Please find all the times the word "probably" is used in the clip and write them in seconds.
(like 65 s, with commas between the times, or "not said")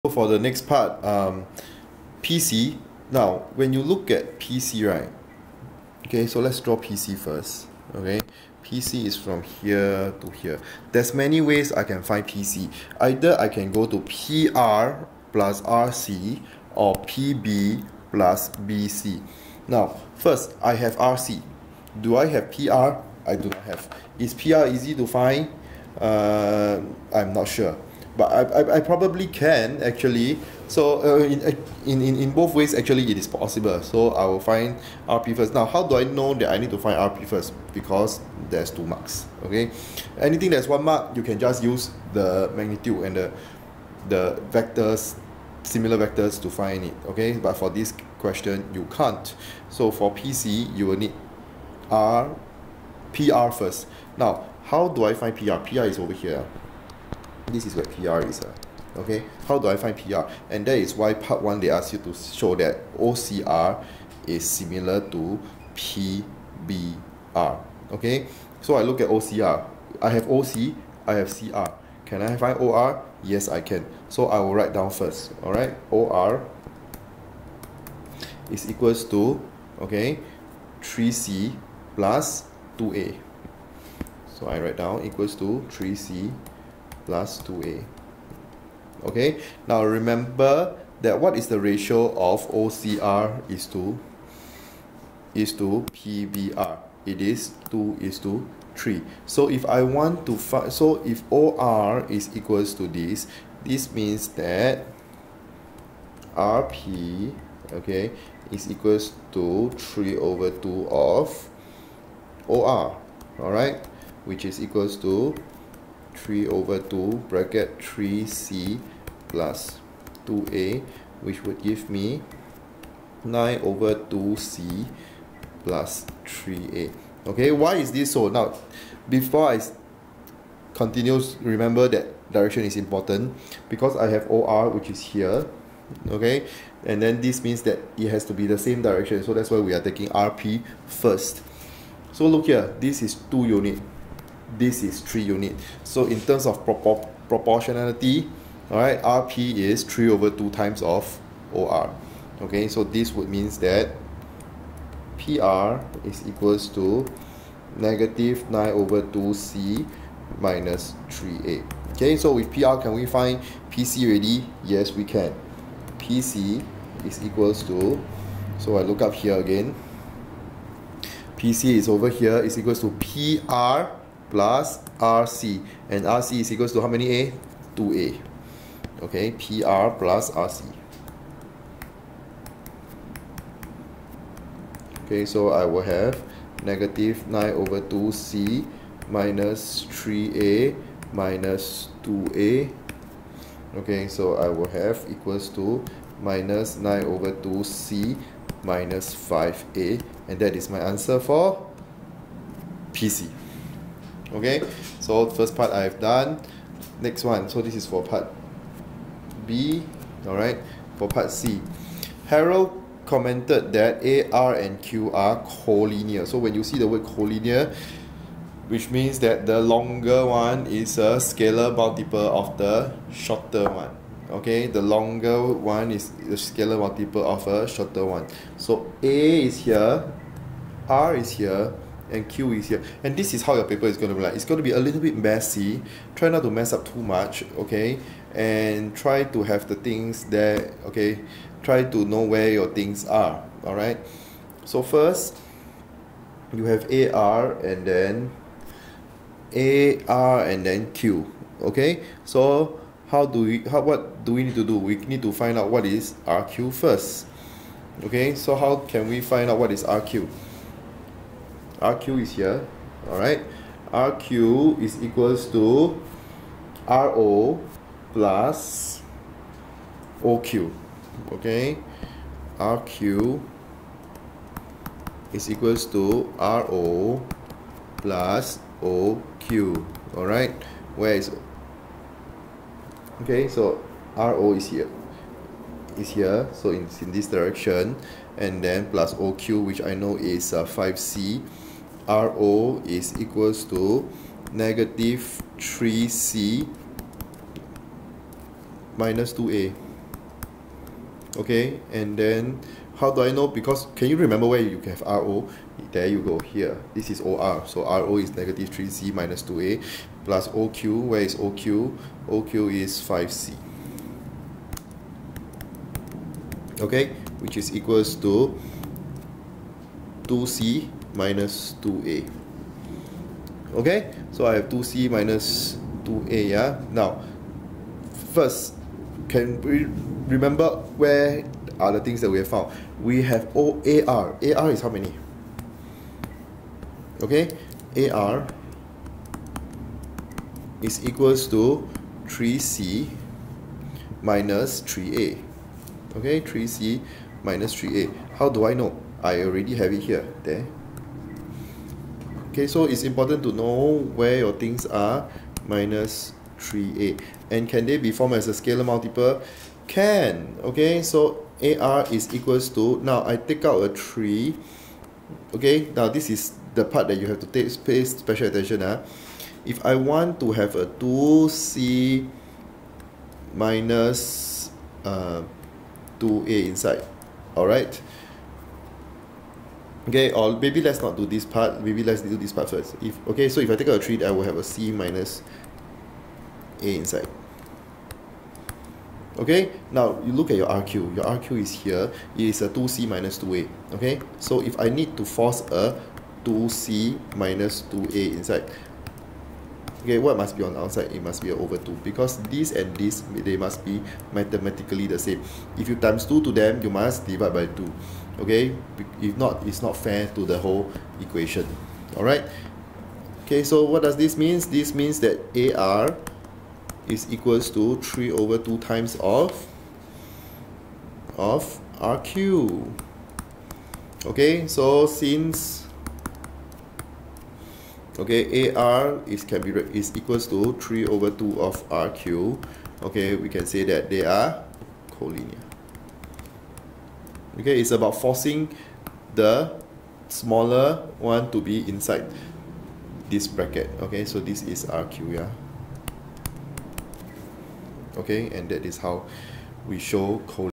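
28 s.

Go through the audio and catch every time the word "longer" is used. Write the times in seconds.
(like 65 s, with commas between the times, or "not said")
219 s, 224 s.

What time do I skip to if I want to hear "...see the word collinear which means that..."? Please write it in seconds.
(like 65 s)
216 s.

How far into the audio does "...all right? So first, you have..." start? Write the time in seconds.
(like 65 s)
243 s.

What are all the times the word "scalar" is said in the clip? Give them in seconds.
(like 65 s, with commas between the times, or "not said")
221 s, 226 s, 358 s.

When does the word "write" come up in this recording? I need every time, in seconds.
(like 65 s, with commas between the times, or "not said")
74 s, 84 s.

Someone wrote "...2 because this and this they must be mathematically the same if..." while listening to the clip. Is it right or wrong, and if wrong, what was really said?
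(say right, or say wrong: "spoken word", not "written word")
right.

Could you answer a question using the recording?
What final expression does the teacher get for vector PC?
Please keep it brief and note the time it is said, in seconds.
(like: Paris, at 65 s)
-9/2 c - 5a, at 196 s.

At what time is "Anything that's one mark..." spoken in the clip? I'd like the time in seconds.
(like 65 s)
40 s.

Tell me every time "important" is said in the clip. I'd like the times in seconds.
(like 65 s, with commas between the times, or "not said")
132 s, 353 s.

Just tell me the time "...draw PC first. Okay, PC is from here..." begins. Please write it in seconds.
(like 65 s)
6 s.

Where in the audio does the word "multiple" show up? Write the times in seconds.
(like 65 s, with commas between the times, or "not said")
221 s, 226 s, 358 s.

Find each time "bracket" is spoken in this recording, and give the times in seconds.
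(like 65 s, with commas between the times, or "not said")
117 s, 443 s.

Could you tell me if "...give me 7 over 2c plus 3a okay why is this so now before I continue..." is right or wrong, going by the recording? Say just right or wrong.
wrong.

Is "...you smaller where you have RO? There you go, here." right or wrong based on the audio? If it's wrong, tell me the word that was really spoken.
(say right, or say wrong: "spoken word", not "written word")
wrong: "remember", not "smaller".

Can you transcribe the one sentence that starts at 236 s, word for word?
Try not to mess up too much, okay?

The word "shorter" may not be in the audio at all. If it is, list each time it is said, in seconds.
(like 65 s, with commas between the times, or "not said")
223 s, 227 s.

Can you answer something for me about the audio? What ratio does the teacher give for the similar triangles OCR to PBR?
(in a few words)
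2 to 3.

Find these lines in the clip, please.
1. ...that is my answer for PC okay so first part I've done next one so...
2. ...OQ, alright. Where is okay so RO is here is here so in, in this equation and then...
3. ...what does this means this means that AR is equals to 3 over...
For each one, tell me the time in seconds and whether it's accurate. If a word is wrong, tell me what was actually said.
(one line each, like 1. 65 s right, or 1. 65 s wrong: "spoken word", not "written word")
1. 200 s right
2. 278 s wrong: "direction", not "equation"
3. 413 s right.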